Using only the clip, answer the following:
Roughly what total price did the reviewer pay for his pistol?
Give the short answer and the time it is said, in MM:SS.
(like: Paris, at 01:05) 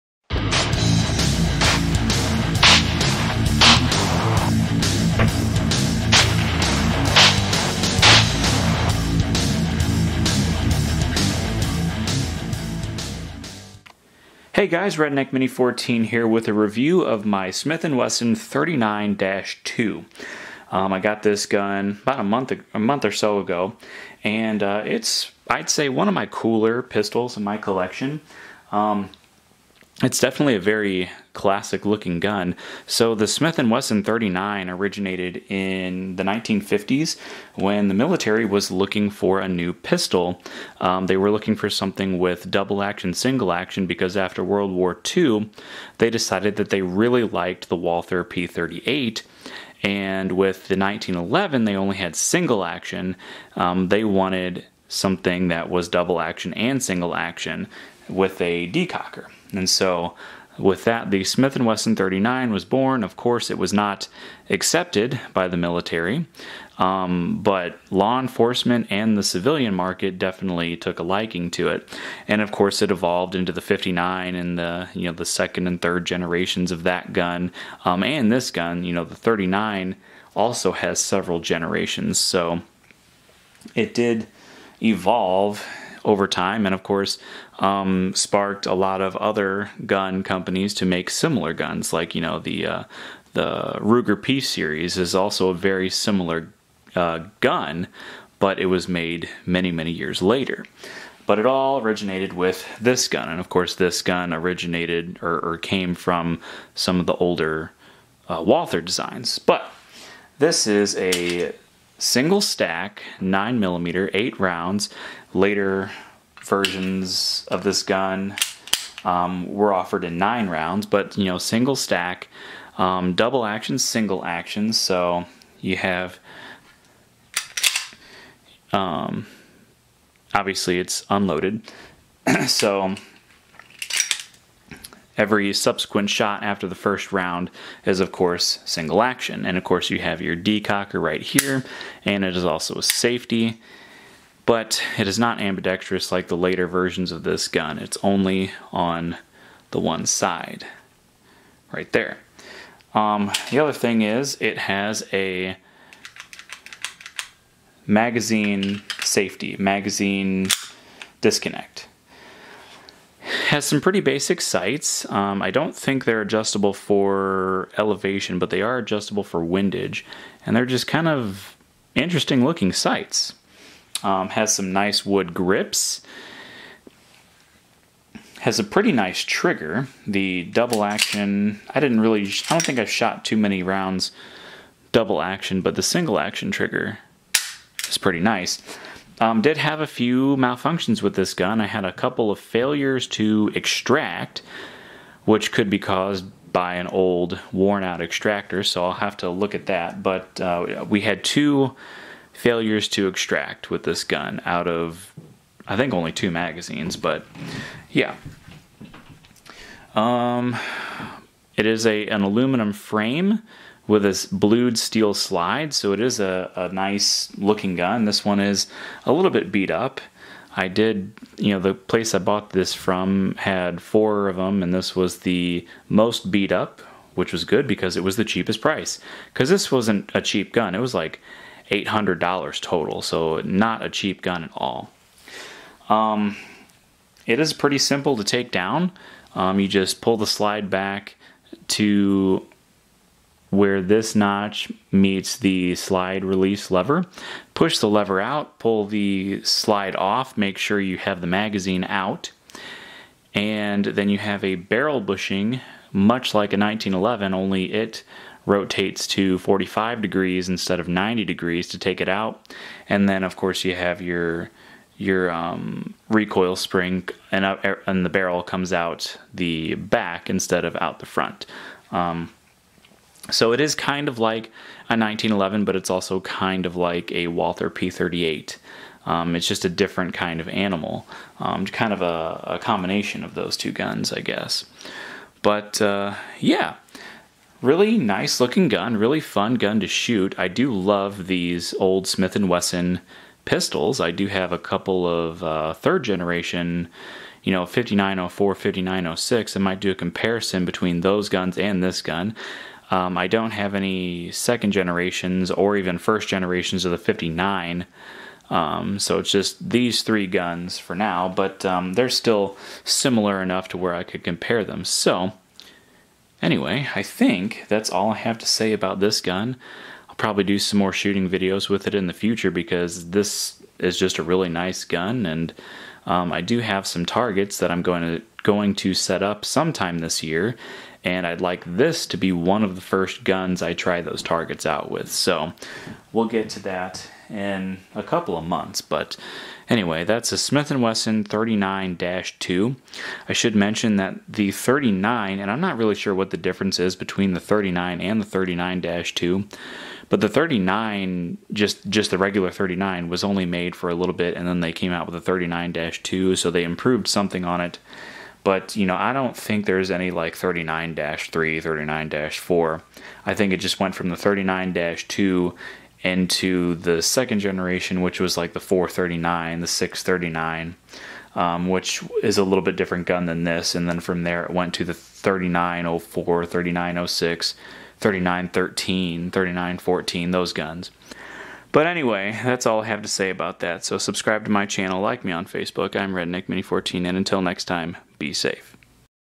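$800, at 03:51.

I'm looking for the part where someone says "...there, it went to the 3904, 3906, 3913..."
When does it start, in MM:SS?
06:14.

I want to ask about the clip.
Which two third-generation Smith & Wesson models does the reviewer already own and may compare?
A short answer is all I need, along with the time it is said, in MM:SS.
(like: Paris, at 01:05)
5904 and 5906, at 04:57.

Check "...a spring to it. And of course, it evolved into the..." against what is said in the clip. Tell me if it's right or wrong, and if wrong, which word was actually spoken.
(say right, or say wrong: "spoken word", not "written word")
wrong: "liking", not "spring".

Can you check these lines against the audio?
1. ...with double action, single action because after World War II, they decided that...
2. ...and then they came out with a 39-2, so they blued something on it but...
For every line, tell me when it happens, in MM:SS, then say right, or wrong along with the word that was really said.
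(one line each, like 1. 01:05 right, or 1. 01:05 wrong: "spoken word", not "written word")
1. 00:42 right
2. 05:54 wrong: "improved", not "blued".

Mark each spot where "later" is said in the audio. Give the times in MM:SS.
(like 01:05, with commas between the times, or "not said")
01:40, 01:55, 02:26.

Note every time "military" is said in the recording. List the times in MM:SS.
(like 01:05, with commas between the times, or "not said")
00:37, 01:05.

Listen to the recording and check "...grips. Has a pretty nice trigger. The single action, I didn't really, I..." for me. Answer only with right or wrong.
wrong.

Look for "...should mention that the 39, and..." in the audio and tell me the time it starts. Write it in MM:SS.
05:43.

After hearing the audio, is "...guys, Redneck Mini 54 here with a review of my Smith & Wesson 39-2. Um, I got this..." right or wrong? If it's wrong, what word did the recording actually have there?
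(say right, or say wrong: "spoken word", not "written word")
wrong: "14", not "54".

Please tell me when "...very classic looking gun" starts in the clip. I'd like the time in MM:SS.
00:30.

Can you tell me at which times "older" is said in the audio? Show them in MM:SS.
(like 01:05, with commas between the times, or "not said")
01:47.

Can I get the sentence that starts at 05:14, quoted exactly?
So, anyway, I think that's all I have to say about this gun.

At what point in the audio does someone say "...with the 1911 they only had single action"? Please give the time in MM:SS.
00:50.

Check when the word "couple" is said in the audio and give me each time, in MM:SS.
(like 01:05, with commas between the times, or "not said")
03:11, 04:54, 05:38.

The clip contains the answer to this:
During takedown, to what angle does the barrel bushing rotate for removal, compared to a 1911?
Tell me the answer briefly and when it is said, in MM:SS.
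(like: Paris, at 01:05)
45 degrees, at 04:19.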